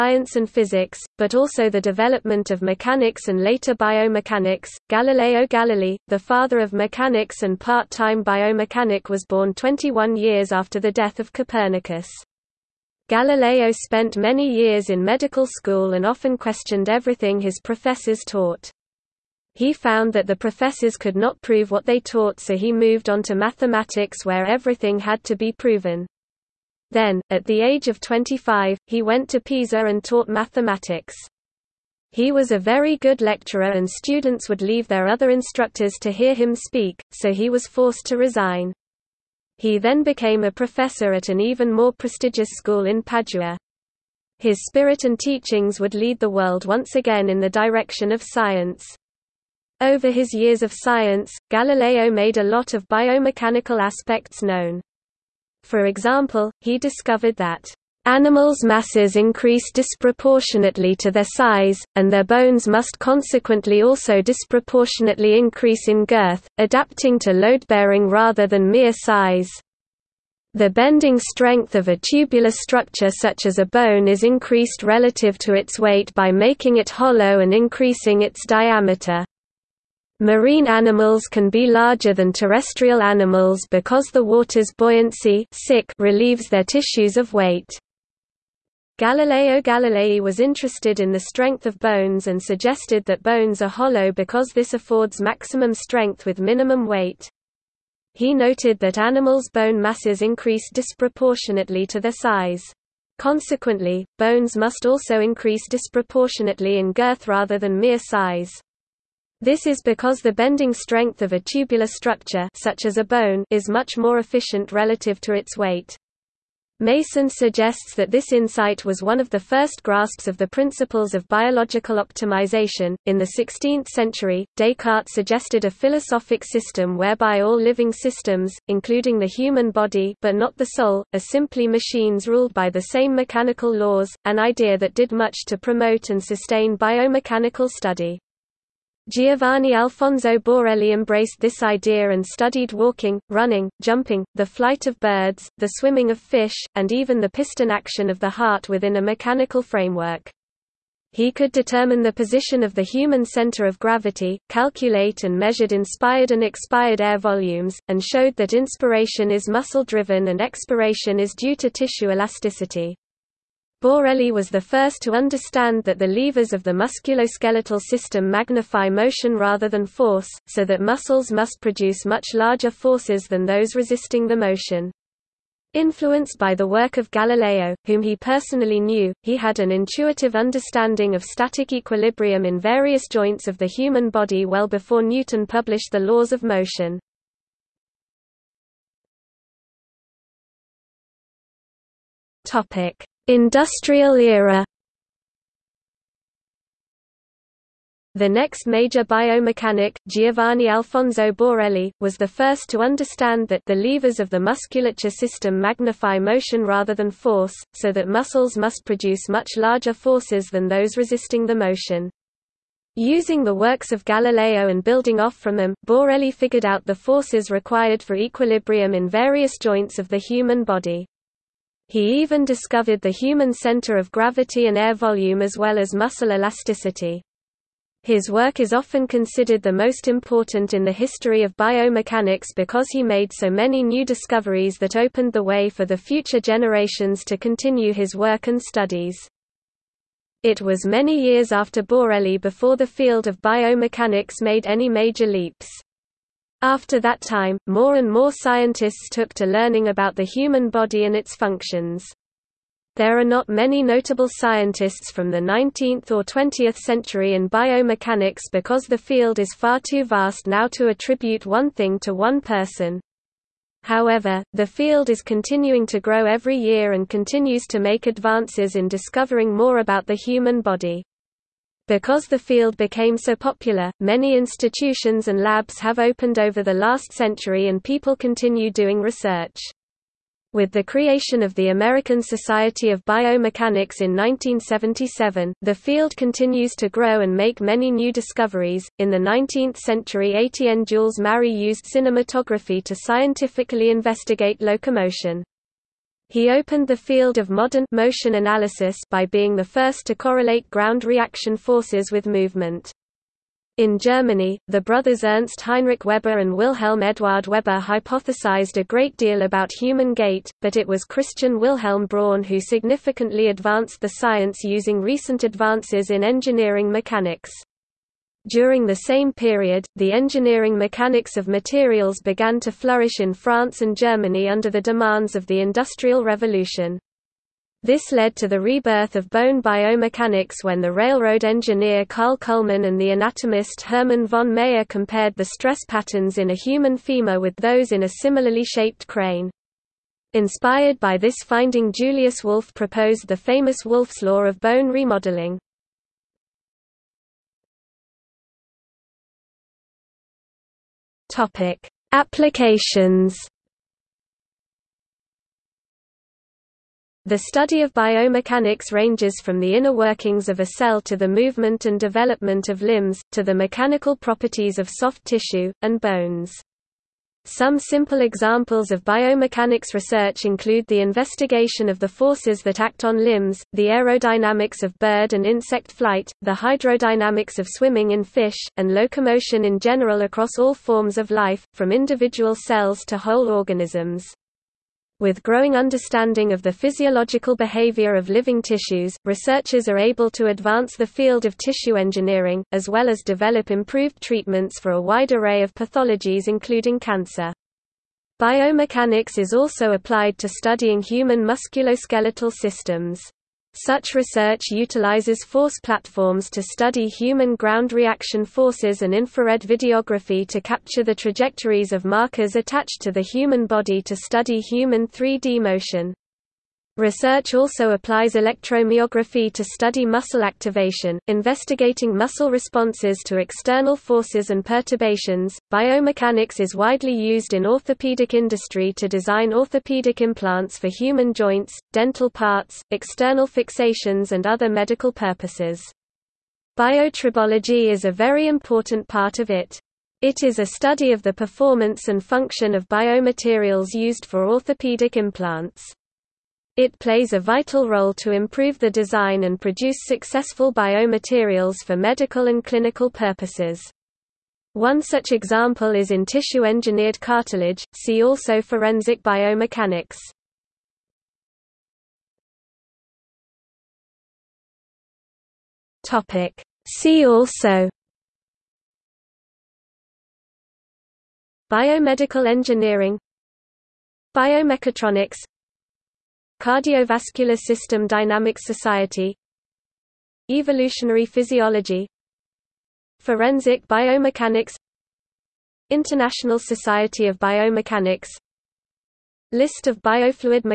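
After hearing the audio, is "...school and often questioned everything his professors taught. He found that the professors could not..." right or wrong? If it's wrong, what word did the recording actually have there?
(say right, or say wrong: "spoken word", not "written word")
right.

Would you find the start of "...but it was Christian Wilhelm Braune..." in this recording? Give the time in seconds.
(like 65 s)
310 s.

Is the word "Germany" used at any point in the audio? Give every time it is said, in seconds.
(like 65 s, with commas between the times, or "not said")
303 s, 323 s.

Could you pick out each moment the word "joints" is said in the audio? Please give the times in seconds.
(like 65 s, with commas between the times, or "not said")
183 s, 219 s, 431 s.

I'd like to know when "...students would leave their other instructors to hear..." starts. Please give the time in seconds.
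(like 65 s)
33 s.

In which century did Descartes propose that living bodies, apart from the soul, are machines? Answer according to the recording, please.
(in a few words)
16th century.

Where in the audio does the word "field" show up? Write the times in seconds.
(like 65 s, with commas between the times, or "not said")
242 s, 258 s, 264 s, 272 s, 285 s, 296 s, 391 s.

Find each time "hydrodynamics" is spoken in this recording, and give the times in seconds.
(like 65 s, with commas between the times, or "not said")
376 s.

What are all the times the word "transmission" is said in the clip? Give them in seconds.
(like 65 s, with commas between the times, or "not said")
not said.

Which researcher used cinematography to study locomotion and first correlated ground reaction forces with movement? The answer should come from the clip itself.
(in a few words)
Etienne Jules Marey.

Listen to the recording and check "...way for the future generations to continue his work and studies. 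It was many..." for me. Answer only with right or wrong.
right.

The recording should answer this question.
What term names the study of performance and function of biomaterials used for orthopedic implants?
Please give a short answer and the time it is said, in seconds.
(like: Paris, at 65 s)
Biotribology, at 436 s.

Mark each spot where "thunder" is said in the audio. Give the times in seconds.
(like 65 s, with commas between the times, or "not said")
not said.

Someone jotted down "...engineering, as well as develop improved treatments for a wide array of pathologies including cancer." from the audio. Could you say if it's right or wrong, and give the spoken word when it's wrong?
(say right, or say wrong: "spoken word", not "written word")
right.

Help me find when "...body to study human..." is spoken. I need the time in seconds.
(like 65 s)
413 s.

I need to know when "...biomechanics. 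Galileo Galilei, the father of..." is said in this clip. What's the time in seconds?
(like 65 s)
3 s.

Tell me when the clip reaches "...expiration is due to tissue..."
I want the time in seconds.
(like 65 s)
160 s.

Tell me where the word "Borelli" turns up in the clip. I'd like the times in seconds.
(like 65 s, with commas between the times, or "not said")
140 s, 163 s, 201 s, 215 s, 241 s.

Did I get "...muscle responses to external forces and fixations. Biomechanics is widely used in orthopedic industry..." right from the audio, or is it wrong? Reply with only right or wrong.
wrong.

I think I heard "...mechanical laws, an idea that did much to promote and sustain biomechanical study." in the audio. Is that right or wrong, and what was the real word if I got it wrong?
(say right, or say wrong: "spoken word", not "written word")
right.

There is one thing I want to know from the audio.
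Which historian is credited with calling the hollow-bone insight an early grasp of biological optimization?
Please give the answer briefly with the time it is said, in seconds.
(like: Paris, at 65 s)
Mason, at 116 s.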